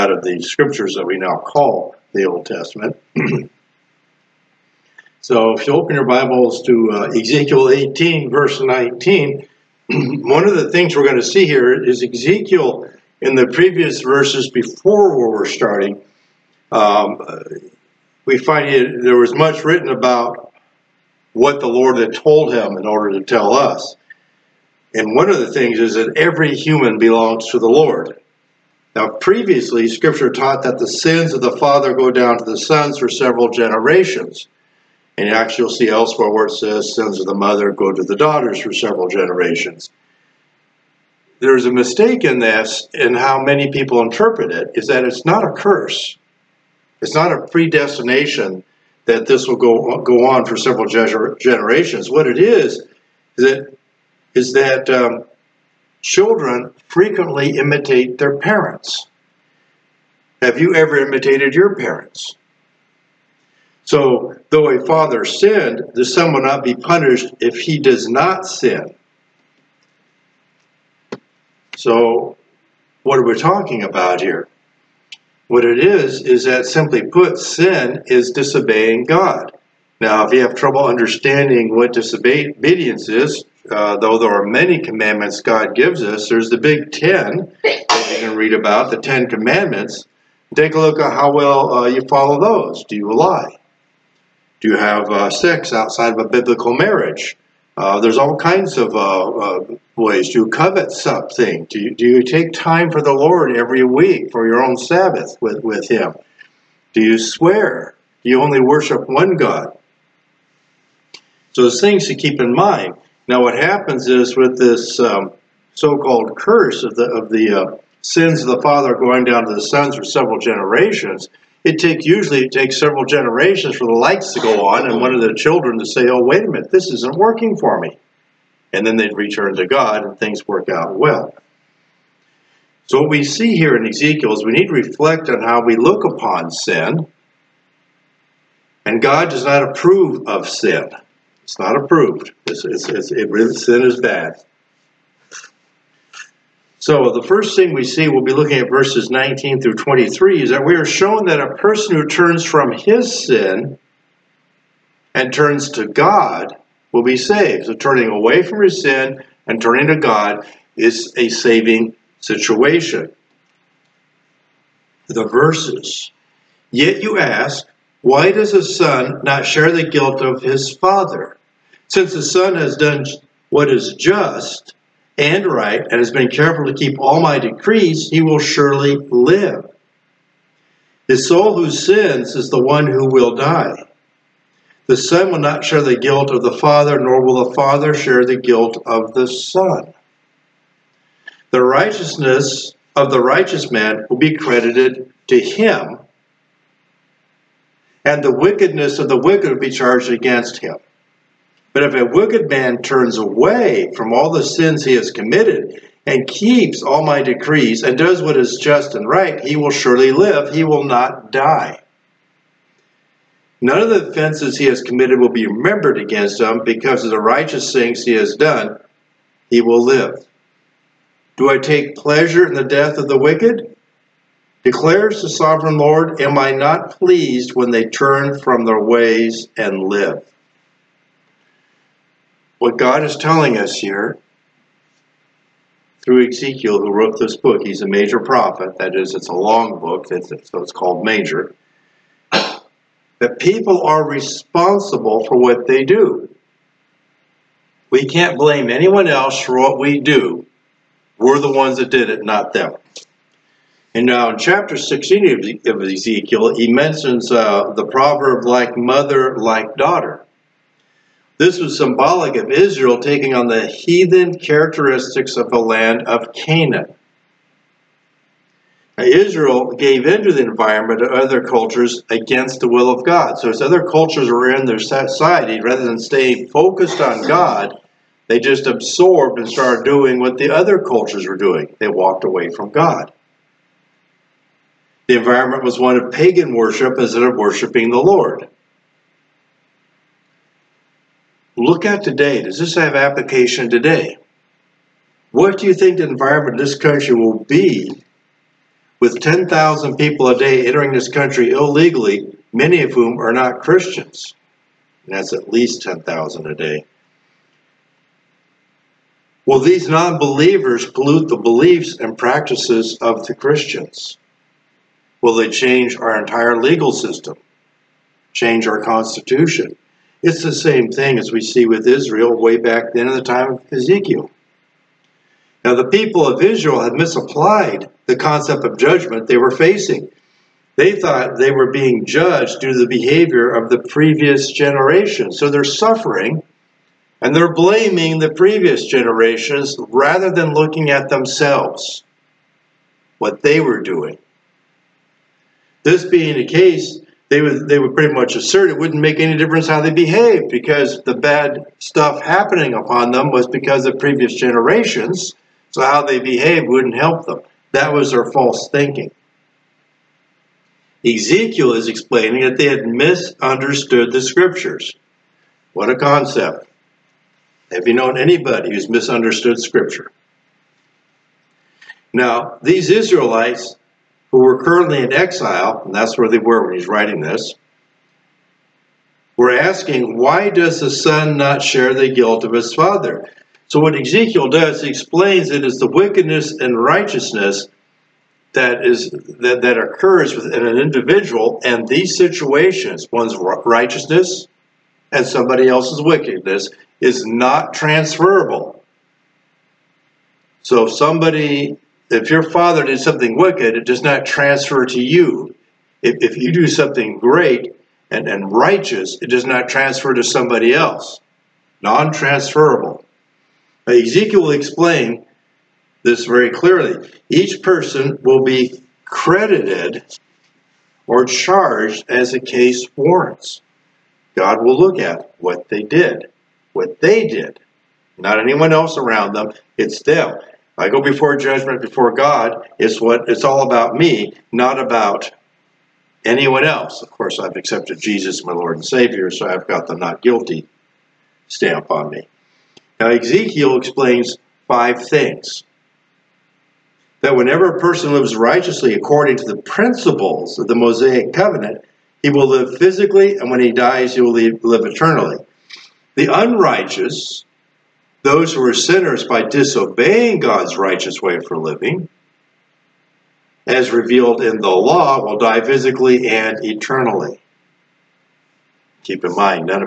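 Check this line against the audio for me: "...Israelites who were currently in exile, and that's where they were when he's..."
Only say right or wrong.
right.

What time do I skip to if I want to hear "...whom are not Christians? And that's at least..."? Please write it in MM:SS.
05:02.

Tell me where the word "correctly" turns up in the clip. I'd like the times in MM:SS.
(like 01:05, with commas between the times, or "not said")
not said.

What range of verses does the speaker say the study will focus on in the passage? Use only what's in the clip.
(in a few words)
19 through 23.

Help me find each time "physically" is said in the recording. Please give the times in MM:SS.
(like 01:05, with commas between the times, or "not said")
07:32, 07:45.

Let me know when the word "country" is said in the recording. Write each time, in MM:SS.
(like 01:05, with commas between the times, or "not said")
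04:56, 05:01.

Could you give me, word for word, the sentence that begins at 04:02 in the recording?
That people are responsible for what they do.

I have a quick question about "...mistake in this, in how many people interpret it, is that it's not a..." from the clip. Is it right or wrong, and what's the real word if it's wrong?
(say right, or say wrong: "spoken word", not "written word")
right.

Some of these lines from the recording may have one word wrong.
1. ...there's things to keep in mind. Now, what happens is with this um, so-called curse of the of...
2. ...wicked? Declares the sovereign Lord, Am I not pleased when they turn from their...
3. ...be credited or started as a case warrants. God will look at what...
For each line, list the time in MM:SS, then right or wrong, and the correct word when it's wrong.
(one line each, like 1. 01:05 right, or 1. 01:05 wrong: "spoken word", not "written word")
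1. 01:51 right
2. 03:43 right
3. 06:58 wrong: "charged", not "started".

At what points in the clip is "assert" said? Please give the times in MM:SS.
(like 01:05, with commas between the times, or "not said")
05:48.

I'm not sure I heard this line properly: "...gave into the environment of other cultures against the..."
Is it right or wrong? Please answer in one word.
right.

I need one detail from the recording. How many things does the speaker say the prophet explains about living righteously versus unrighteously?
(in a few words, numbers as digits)
5.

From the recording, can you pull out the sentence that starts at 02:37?
So turning away from his sin and turning to God is a saving situation.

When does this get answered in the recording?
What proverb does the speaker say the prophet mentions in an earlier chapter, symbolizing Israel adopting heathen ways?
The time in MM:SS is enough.
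04:18.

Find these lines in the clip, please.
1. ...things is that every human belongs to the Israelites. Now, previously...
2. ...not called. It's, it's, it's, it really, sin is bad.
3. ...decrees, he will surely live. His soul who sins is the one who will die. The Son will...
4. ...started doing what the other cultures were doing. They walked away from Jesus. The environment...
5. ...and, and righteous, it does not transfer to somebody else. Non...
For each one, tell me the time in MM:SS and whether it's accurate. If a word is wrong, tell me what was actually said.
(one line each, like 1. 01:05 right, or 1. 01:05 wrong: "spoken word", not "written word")
1. 00:25 wrong: "Lord", not "Israelites"
2. 02:21 wrong: "approved", not "called"
3. 02:57 right
4. 04:39 wrong: "God", not "Jesus"
5. 06:48 right.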